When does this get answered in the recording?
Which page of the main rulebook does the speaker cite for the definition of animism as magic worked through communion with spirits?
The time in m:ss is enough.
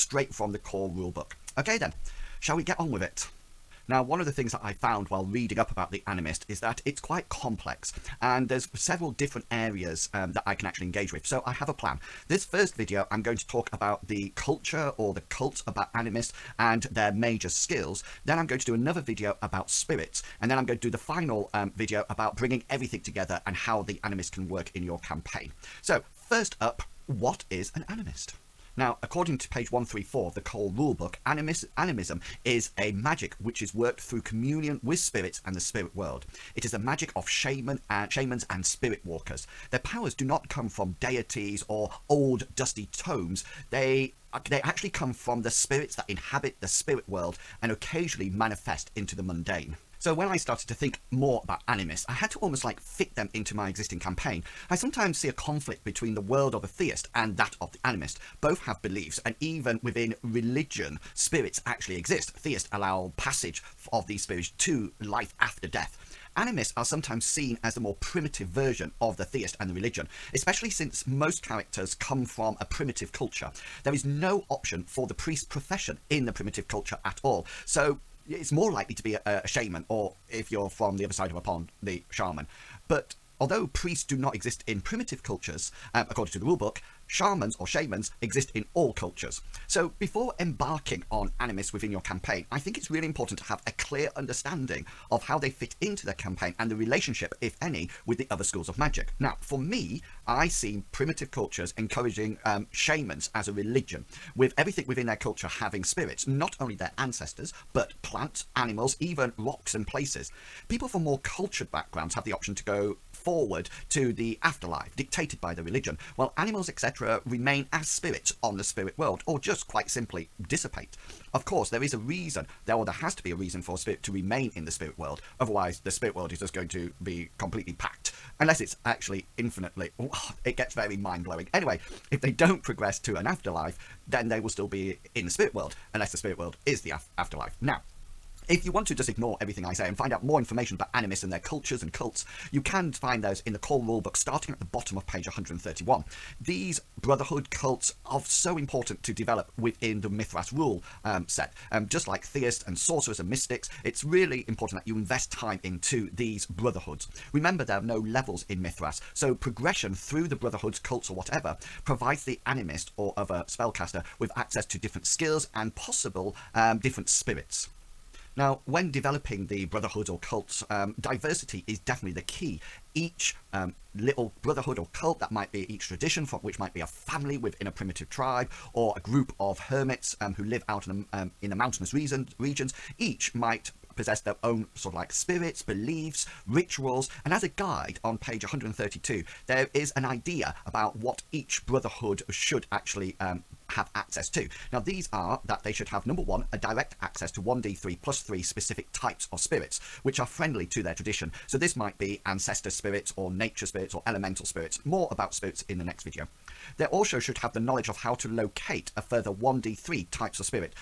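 0:29.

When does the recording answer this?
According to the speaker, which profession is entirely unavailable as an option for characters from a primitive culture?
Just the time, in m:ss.
1:15.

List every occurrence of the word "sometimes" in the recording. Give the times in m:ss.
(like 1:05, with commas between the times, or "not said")
0:54, 1:06.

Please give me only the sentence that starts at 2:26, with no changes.
These brotherhood cults are so important to develop within the Mythras rule um, set.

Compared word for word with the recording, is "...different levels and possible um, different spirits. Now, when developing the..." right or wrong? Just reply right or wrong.
wrong.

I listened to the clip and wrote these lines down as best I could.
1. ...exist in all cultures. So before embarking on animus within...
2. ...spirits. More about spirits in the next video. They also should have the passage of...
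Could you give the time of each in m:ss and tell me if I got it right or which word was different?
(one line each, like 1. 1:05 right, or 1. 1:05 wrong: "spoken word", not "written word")
1. 1:28 right
2. 3:24 wrong: "knowledge", not "passage".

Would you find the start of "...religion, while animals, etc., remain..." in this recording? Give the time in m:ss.
1:55.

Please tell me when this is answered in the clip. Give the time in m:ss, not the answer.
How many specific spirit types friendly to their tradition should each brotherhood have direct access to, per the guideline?
3:17.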